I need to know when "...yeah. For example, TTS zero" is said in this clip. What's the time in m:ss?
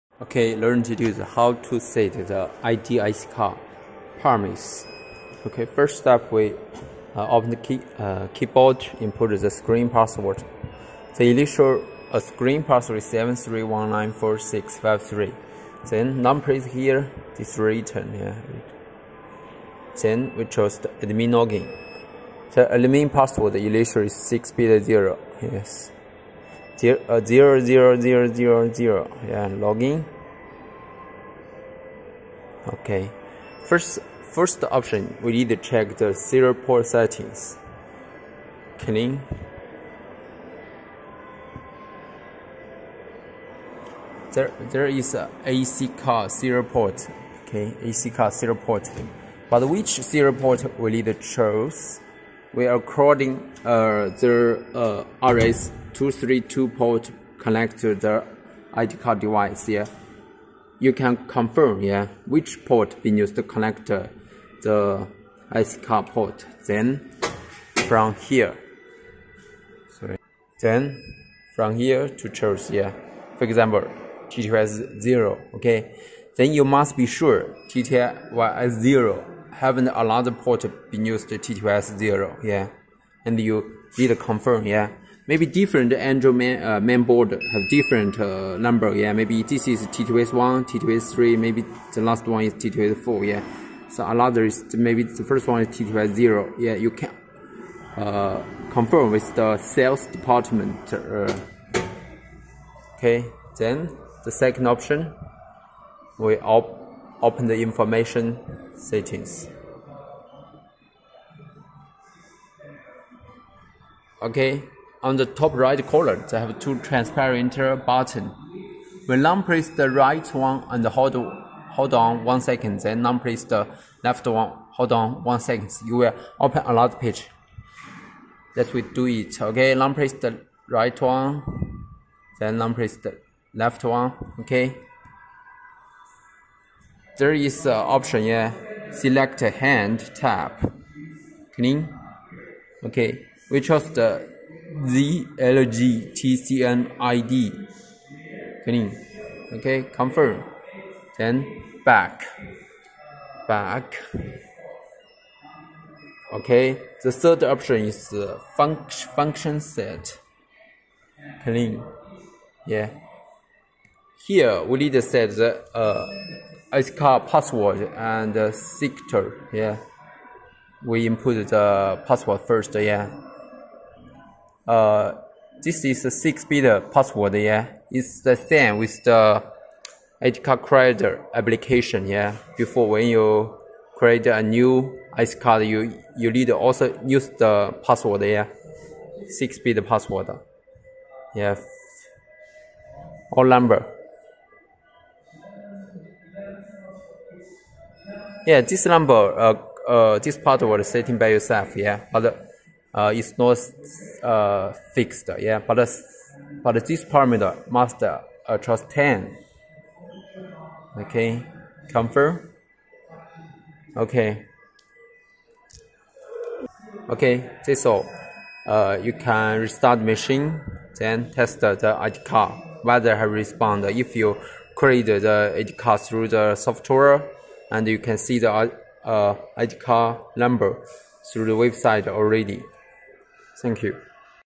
1:12.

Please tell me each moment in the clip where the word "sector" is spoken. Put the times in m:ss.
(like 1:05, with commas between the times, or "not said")
2:48.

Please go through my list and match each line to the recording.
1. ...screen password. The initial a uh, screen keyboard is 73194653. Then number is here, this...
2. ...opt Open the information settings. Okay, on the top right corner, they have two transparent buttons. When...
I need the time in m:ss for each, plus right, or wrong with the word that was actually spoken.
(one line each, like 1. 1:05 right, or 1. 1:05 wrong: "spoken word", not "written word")
1. 0:09 wrong: "password", not "keyboard"
2. 1:46 right.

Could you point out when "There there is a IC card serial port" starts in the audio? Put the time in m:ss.
0:44.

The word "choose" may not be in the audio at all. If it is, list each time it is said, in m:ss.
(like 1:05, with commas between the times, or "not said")
0:20, 0:51, 1:12.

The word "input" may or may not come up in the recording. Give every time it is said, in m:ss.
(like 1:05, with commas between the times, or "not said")
0:08, 2:51.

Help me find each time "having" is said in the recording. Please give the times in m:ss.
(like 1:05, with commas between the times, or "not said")
1:19.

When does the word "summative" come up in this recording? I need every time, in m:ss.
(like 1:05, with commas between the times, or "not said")
not said.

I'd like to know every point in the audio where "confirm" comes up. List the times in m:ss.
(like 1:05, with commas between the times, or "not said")
1:01, 1:24, 1:38, 2:29, 3:31.